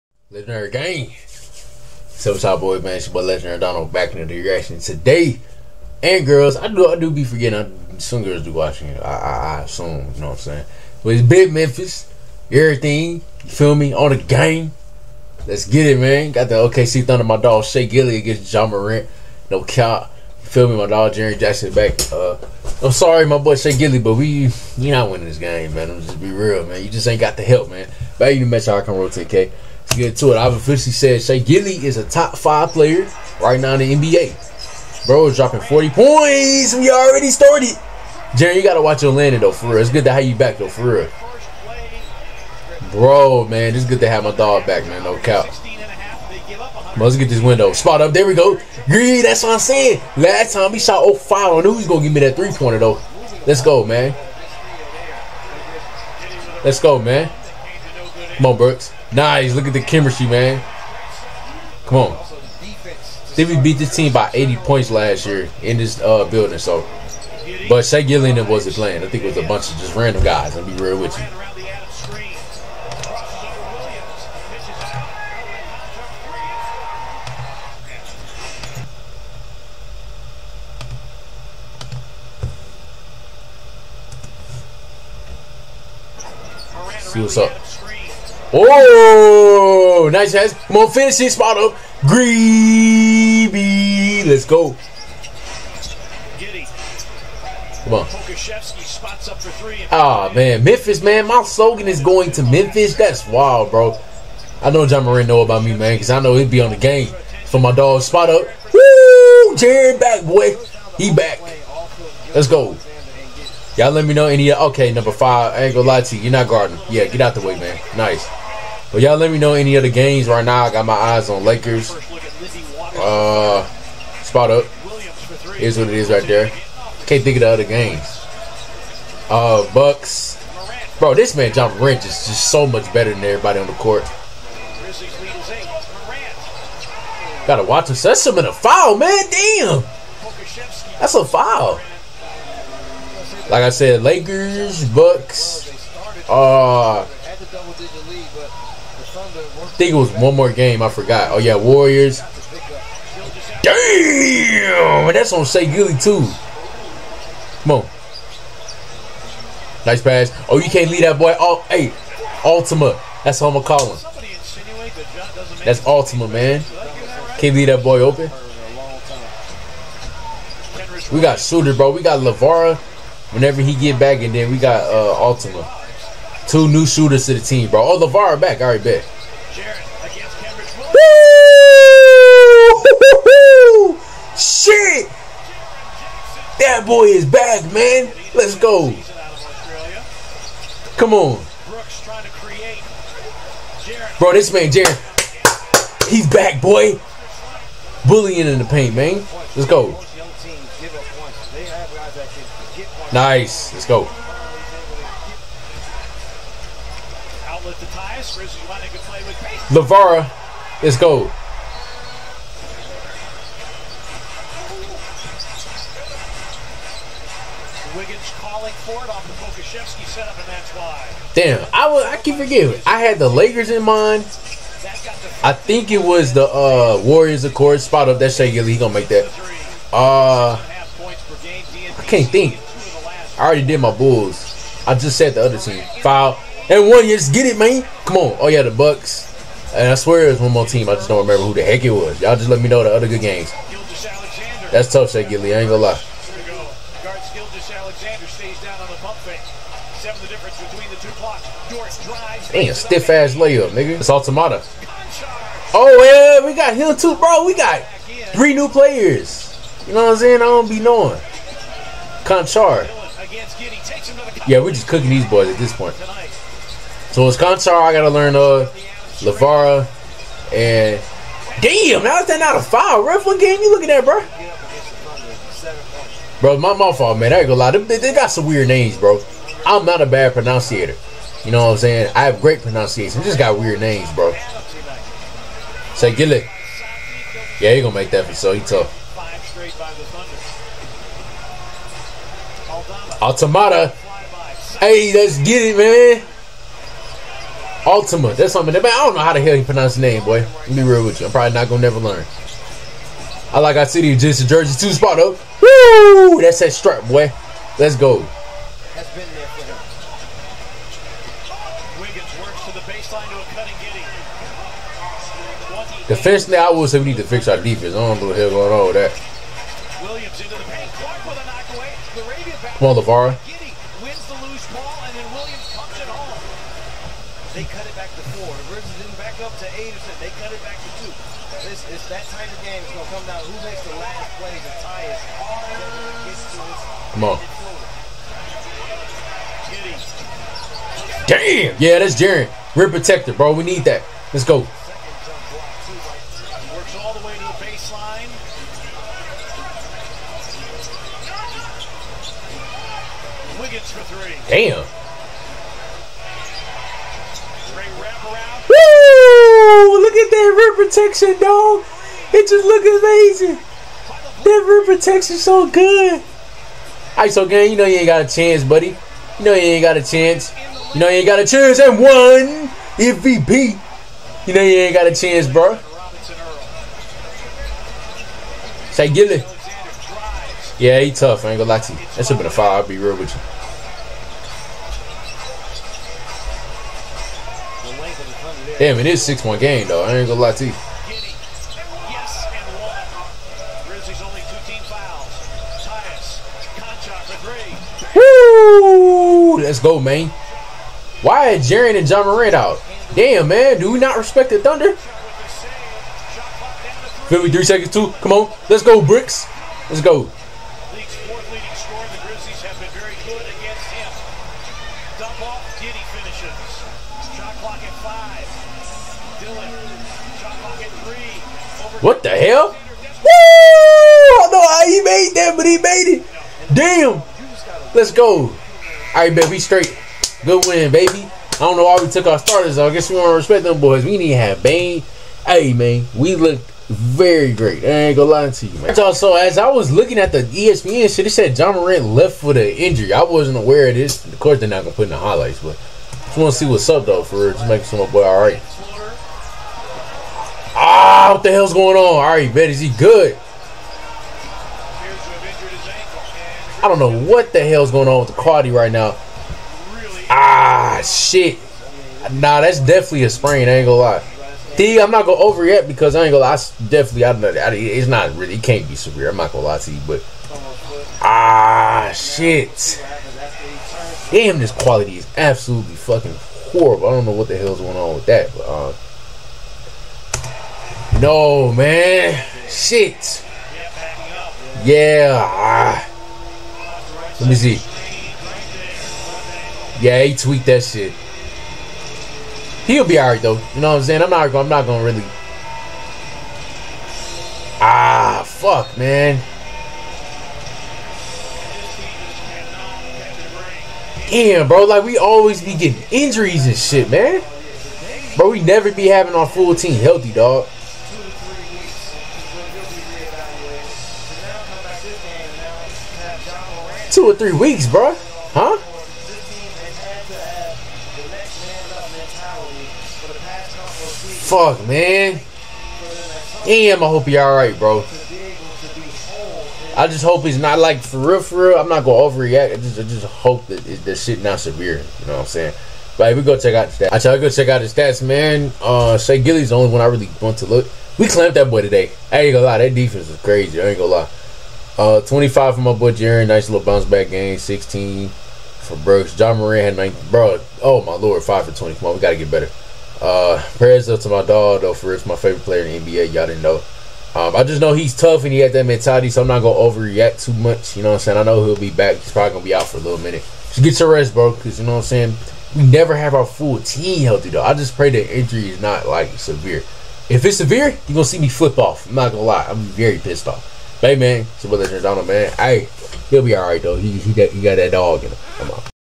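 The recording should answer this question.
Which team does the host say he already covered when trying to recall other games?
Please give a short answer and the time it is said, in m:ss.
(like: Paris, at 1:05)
Bulls, at 3:53.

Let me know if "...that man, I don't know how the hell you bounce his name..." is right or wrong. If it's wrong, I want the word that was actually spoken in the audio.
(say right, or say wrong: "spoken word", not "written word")
wrong: "pronounce", not "bounce".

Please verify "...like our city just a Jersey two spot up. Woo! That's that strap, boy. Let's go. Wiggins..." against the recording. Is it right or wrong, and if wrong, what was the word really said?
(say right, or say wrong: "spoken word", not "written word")
right.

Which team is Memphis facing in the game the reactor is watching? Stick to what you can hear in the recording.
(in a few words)
OKC Thunder.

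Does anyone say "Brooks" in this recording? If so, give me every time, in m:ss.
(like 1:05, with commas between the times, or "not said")
0:58, 9:09.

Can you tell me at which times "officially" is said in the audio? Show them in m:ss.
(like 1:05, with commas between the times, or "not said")
0:30.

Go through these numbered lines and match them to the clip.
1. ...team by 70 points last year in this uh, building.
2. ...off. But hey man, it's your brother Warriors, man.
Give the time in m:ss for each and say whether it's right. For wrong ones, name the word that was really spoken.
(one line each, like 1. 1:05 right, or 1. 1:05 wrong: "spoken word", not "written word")
1. 1:03 wrong: "80", not "70"
2. 9:33 wrong: "Giordano", not "Warriors".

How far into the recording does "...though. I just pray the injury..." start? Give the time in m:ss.
9:27.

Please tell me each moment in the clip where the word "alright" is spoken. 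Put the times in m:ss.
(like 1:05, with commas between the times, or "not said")
8:13, 8:47, 9:36.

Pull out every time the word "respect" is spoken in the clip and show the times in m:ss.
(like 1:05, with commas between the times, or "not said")
6:44, 7:13.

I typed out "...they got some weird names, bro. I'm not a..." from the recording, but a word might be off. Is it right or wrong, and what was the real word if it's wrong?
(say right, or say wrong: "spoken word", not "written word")
right.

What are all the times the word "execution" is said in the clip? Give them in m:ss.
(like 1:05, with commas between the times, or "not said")
not said.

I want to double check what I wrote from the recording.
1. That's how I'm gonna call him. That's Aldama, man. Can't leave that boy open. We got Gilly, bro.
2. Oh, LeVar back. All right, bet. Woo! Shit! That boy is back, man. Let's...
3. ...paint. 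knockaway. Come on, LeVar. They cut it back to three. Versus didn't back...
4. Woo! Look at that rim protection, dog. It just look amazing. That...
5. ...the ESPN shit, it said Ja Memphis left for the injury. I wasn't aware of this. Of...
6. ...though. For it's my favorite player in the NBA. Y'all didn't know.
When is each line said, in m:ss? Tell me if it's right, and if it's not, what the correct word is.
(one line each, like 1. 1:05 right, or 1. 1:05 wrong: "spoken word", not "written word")
1. 2:43 wrong: "Shooter", not "Gilly"
2. 2:57 right
3. 5:20 wrong: "four", not "three"
4. 5:57 right
5. 7:20 wrong: "Morant", not "Memphis"
6. 9:14 right.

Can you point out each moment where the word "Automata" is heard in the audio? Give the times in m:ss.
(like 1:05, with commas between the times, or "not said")
4:14, 4:53.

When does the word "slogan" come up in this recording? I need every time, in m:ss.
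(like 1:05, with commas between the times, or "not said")
1:41.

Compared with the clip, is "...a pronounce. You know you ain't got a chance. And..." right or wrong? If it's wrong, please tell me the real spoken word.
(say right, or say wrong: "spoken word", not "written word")
wrong: "chance", not "pronounce".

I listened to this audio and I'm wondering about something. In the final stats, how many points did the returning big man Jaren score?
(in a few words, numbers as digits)
25.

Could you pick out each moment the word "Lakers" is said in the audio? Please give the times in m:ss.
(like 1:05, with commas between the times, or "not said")
2:01, 2:24, 3:43.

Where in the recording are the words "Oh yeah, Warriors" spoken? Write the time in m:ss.
2:31.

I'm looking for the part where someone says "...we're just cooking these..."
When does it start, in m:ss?
4:24.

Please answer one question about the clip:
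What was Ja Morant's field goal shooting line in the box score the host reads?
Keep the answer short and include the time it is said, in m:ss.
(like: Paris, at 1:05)
5 for 20, at 9:11.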